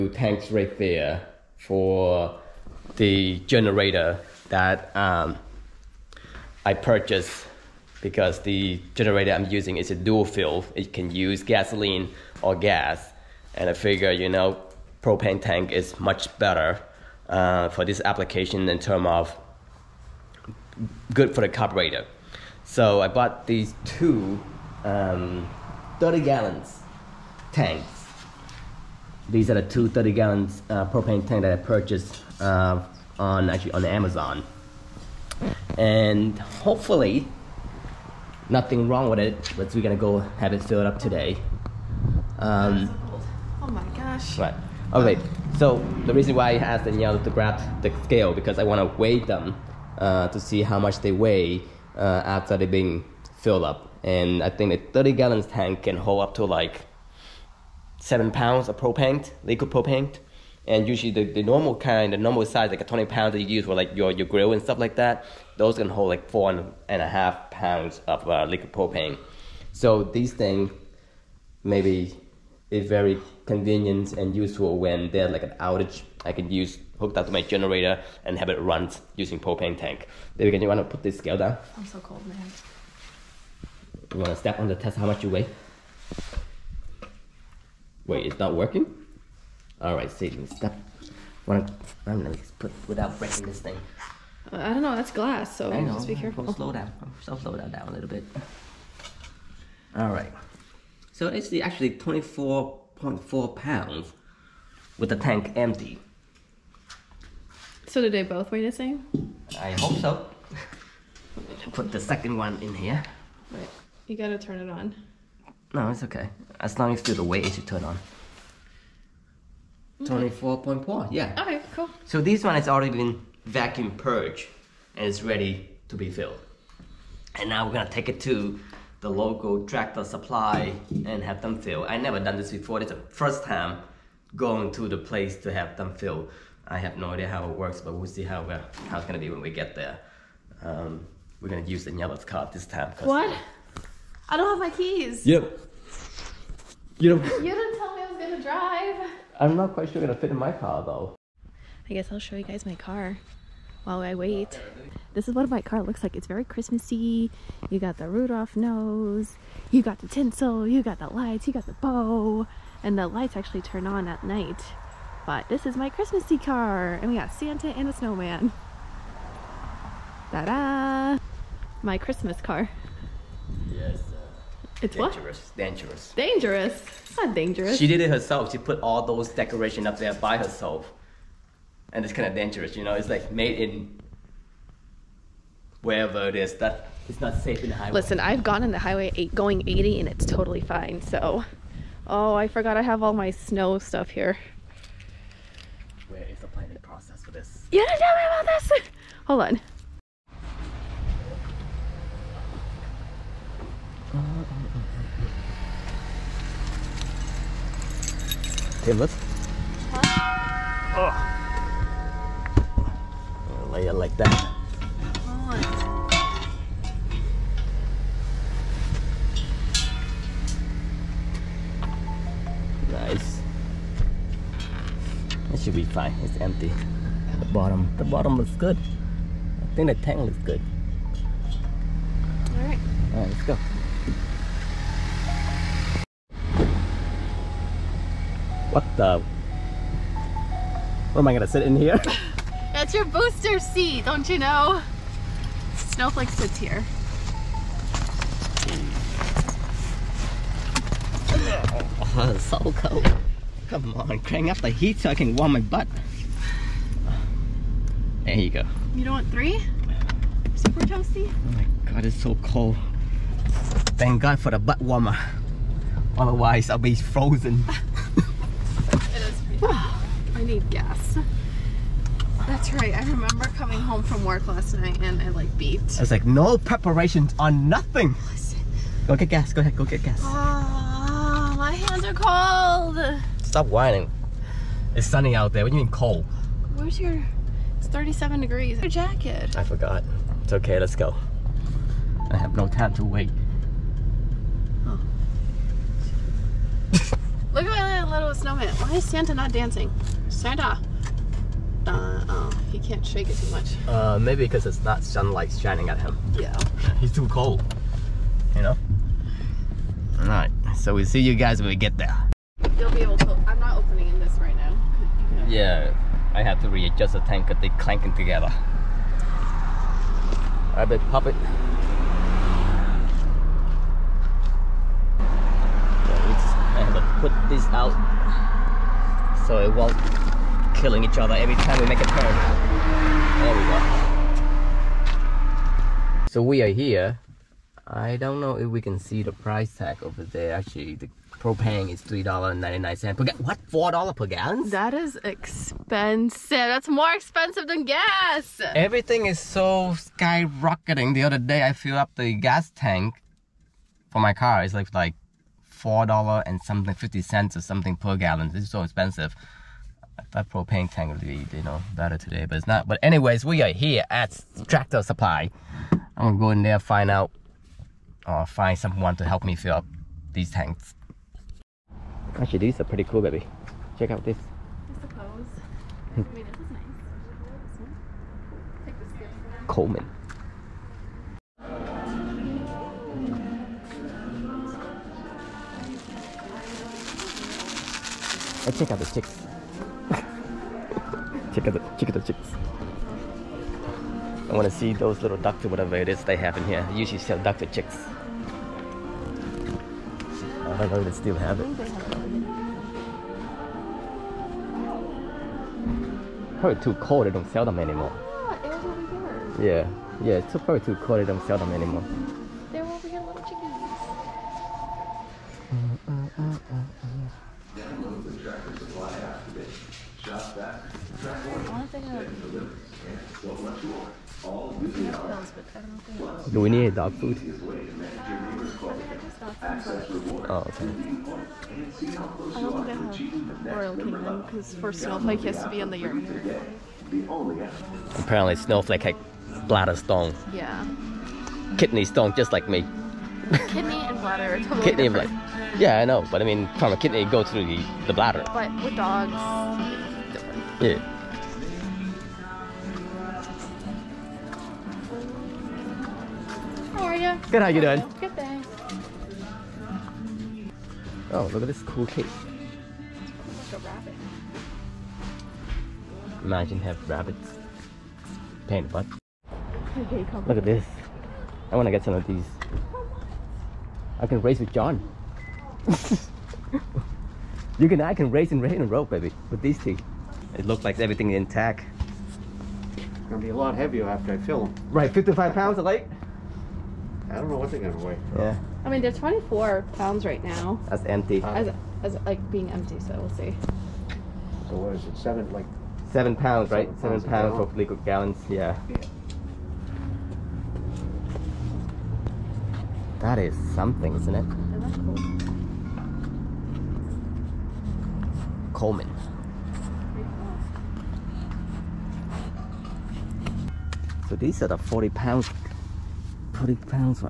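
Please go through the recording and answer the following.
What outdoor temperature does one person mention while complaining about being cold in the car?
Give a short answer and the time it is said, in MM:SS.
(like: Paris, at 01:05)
37 degrees, at 04:47.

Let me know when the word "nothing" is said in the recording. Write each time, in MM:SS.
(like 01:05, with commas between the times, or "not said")
00:38, 04:37.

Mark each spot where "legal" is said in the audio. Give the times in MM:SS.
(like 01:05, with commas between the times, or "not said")
08:17.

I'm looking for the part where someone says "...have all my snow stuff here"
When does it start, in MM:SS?
03:12.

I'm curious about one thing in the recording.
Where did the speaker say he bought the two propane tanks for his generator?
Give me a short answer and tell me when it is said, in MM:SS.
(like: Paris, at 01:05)
Amazon, at 00:33.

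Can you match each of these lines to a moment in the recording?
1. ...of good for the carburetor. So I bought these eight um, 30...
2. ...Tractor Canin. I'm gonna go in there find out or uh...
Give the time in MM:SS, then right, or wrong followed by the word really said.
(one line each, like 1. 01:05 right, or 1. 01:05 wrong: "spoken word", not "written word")
1. 00:19 wrong: "two", not "eight"
2. 06:04 wrong: "Supply", not "Canin".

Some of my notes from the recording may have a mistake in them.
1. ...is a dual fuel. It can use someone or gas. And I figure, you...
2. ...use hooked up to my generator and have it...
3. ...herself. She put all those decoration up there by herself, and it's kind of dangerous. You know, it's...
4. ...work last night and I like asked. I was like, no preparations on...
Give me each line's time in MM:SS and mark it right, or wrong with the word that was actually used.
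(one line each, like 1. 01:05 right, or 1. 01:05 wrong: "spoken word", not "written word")
1. 00:09 wrong: "gasoline", not "someone"
2. 01:16 right
3. 02:58 right
4. 04:34 wrong: "beeped", not "asked".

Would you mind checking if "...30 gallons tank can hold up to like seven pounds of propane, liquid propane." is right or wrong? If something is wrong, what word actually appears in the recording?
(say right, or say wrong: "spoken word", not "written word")
right.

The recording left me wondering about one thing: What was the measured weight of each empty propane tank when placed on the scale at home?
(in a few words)
24.4 pounds.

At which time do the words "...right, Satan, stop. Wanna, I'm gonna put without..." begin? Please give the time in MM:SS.
01:29.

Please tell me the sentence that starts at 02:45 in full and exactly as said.
But this is my Christmassy car, and we got Santa and a snowman.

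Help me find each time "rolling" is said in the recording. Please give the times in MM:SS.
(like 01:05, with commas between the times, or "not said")
not said.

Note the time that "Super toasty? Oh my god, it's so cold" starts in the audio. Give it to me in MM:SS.
04:20.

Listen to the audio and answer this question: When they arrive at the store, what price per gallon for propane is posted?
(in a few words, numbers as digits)
$3.99.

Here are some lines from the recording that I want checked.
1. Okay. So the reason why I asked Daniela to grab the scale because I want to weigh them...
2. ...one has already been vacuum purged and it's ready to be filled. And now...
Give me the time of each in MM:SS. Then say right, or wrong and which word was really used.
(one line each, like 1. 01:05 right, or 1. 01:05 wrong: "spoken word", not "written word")
1. 00:44 right
2. 02:02 right.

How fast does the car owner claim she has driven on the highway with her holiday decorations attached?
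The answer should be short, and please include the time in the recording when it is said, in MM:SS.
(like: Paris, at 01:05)
80, at 03:09.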